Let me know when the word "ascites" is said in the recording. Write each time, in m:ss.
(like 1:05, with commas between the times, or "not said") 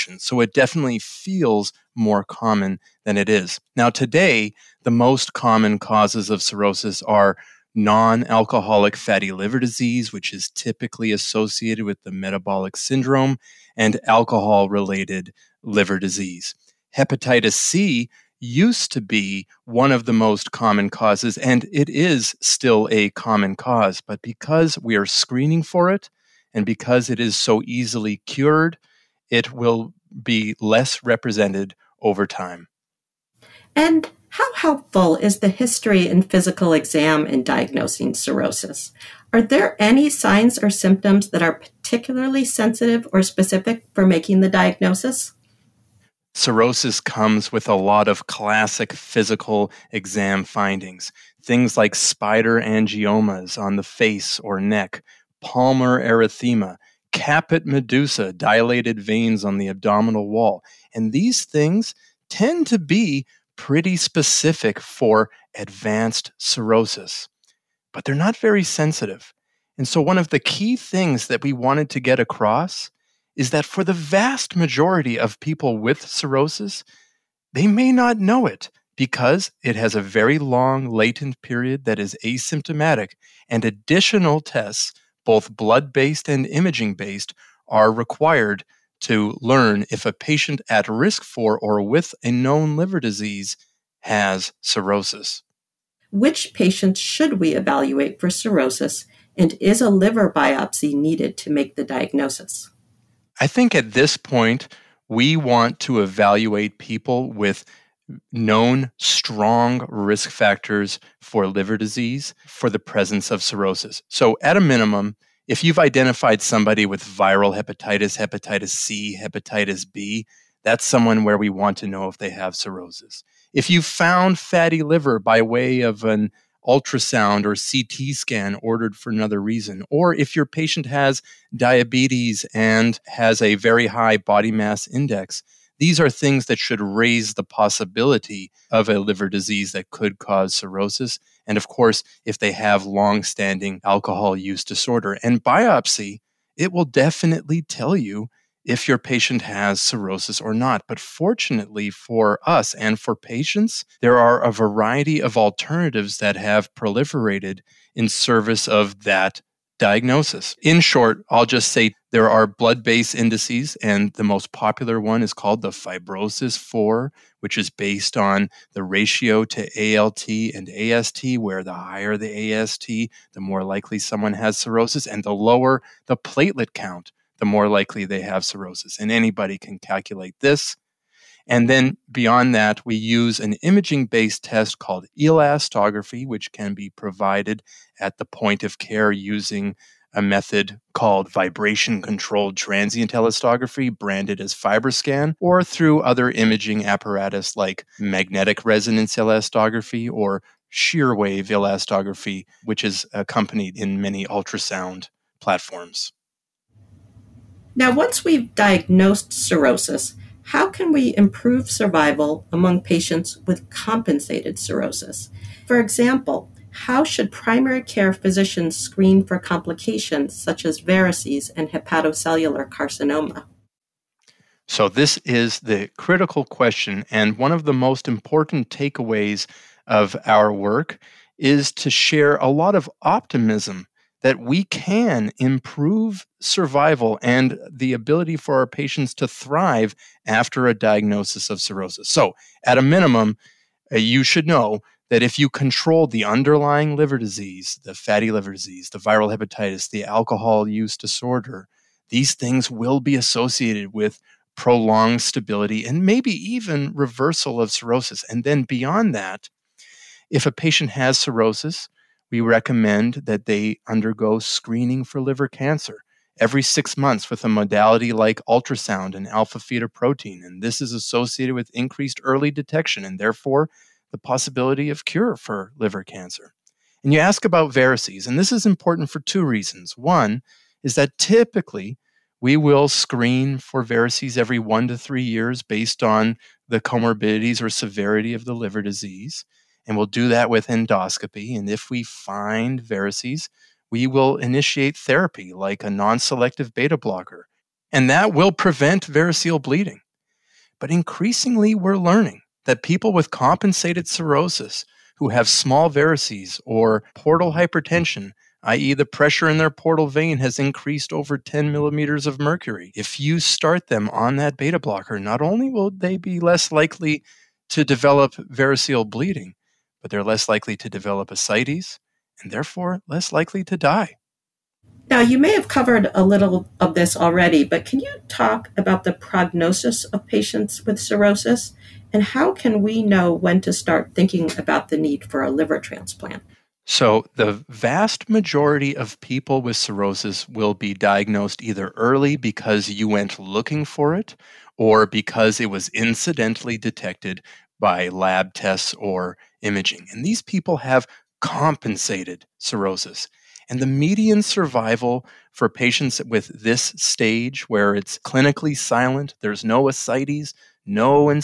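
5:21, 5:59.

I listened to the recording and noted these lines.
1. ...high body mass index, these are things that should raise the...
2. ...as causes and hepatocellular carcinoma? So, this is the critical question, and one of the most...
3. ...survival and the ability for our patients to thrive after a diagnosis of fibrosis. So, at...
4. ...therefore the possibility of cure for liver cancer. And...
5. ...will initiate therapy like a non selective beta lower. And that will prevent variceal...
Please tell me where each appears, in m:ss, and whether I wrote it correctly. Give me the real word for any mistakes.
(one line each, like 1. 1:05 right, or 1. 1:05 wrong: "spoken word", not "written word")
1. 2:13 right
2. 3:40 wrong: "varices", not "causes"
3. 3:56 wrong: "cirrhosis", not "fibrosis"
4. 4:33 right
5. 4:54 wrong: "blocker", not "lower".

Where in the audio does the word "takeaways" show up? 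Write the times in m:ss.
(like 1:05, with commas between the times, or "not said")
3:48.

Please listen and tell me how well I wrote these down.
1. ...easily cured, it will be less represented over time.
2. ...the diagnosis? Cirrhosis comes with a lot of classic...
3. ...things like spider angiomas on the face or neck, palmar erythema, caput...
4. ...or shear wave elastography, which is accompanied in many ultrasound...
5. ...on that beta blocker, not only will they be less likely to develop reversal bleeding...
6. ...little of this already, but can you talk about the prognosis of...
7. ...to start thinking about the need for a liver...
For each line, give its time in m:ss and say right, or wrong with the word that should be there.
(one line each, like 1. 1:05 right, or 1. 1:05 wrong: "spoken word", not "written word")
1. 0:27 right
2. 0:44 right
3. 0:51 right
4. 3:20 right
5. 5:14 wrong: "variceal", not "reversal"
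6. 5:26 right
7. 5:33 right.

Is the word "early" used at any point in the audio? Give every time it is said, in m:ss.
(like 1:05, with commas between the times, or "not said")
4:32, 5:41.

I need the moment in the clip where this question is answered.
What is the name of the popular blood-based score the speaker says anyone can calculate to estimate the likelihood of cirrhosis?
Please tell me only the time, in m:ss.
2:45.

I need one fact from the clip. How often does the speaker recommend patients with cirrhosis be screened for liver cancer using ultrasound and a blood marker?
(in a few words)
every six months.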